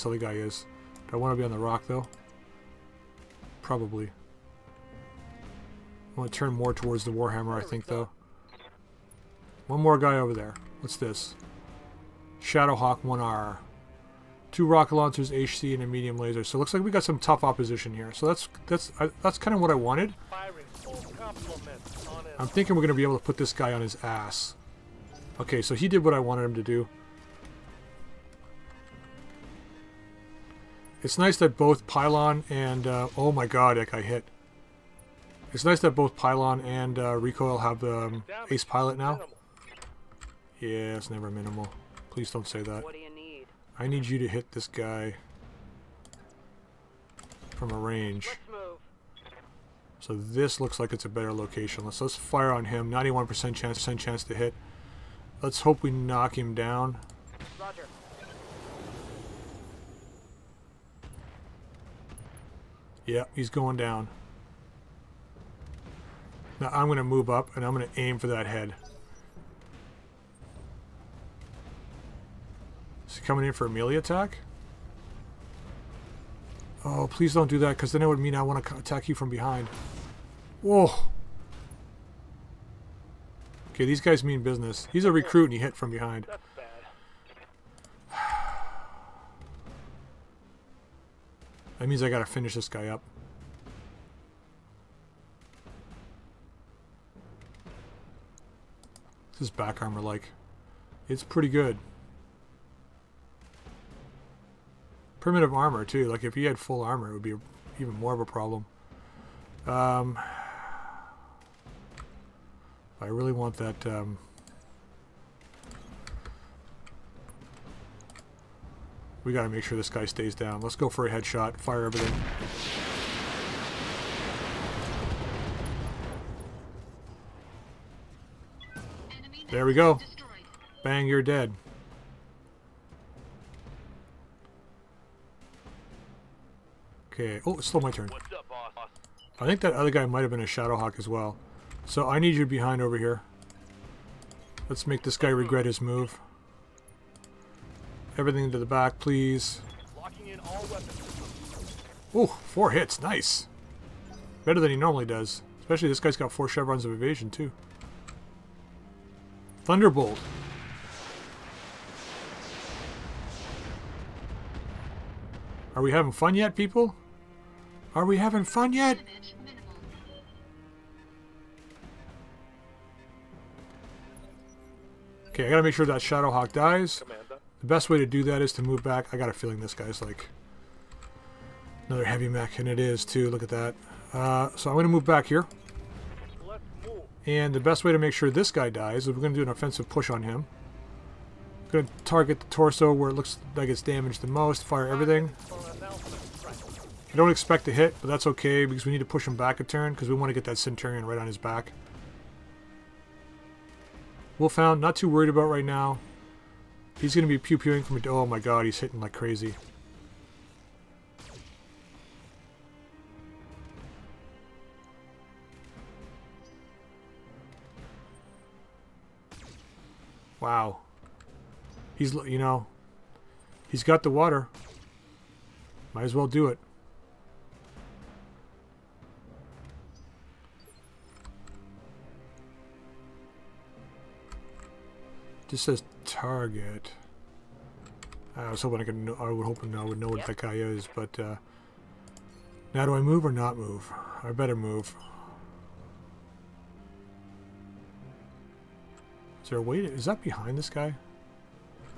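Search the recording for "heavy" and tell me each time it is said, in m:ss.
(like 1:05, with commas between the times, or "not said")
3:02.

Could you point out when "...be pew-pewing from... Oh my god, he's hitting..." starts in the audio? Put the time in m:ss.
3:27.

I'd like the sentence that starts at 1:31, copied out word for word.
That means I gotta finish this guy up.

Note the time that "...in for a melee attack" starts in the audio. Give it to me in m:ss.
1:13.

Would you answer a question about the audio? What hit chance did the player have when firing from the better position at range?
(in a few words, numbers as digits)
91%.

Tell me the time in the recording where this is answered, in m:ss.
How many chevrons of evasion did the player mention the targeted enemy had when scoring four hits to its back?
2:36.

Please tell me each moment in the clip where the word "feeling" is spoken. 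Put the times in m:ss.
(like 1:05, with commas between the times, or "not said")
2:59.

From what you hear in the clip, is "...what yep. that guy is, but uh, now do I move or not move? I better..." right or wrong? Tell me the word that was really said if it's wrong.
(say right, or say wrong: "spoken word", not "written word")
right.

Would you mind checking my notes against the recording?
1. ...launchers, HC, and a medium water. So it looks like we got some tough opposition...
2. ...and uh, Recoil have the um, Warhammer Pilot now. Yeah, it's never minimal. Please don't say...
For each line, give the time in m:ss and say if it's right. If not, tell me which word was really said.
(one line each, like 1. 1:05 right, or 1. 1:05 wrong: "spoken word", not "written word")
1. 0:14 wrong: "laser", not "water"
2. 0:36 wrong: "Ace", not "Warhammer".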